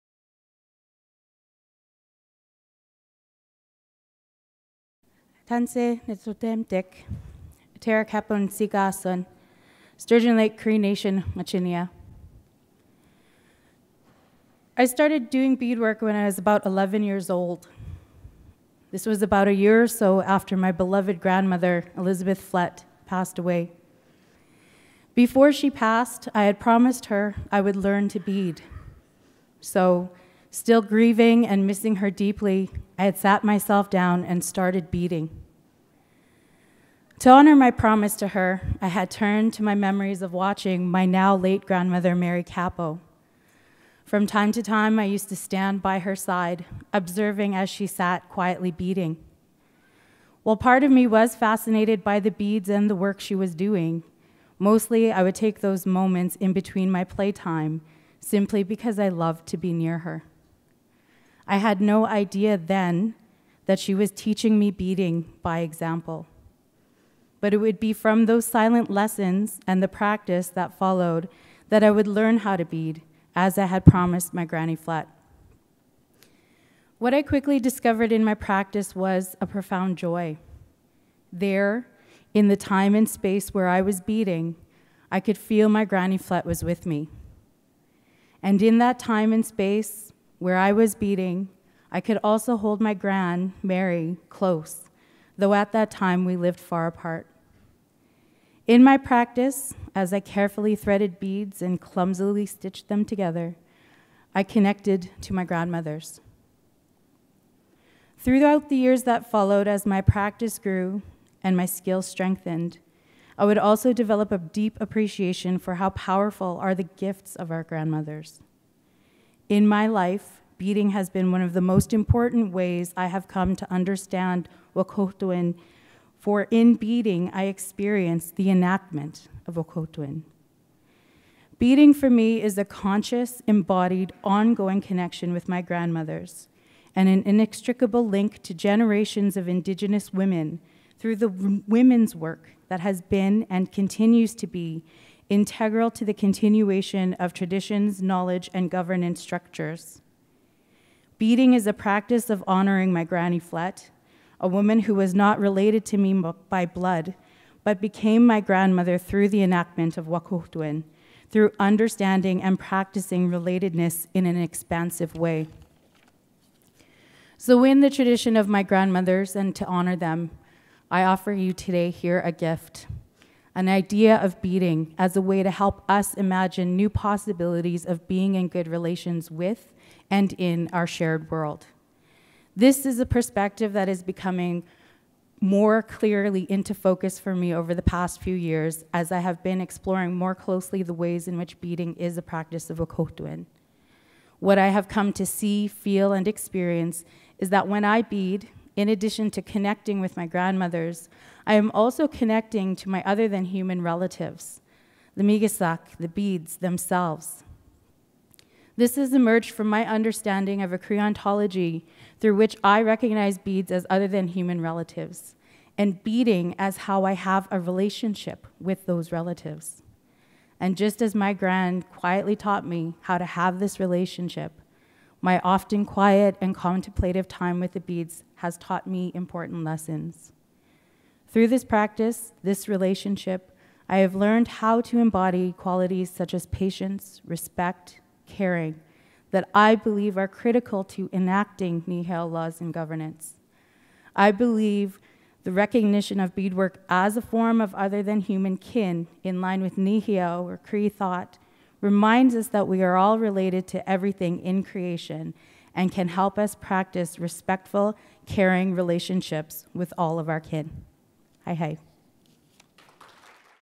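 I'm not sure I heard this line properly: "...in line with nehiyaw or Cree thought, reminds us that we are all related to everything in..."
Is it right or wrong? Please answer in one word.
right.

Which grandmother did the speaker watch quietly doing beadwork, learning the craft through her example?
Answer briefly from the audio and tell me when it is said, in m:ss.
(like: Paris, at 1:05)
Mary Kappo, at 0:42.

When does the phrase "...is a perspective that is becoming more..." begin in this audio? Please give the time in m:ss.
3:02.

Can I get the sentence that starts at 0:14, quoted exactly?
I started doing beadwork when I was about 11 years old.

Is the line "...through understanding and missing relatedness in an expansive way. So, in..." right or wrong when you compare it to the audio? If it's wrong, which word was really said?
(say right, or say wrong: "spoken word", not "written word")
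wrong: "practicing", not "missing".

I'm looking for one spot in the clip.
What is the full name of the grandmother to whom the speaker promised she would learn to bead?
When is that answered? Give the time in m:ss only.
0:21.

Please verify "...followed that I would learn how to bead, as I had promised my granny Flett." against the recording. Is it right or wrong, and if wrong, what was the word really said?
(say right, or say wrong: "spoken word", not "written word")
right.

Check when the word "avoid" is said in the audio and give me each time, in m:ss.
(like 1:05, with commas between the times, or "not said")
not said.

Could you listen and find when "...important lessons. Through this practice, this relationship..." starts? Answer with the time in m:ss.
3:49.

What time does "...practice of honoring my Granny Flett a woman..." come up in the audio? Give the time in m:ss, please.
2:31.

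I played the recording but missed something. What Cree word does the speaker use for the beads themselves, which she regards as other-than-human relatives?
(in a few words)
migasak.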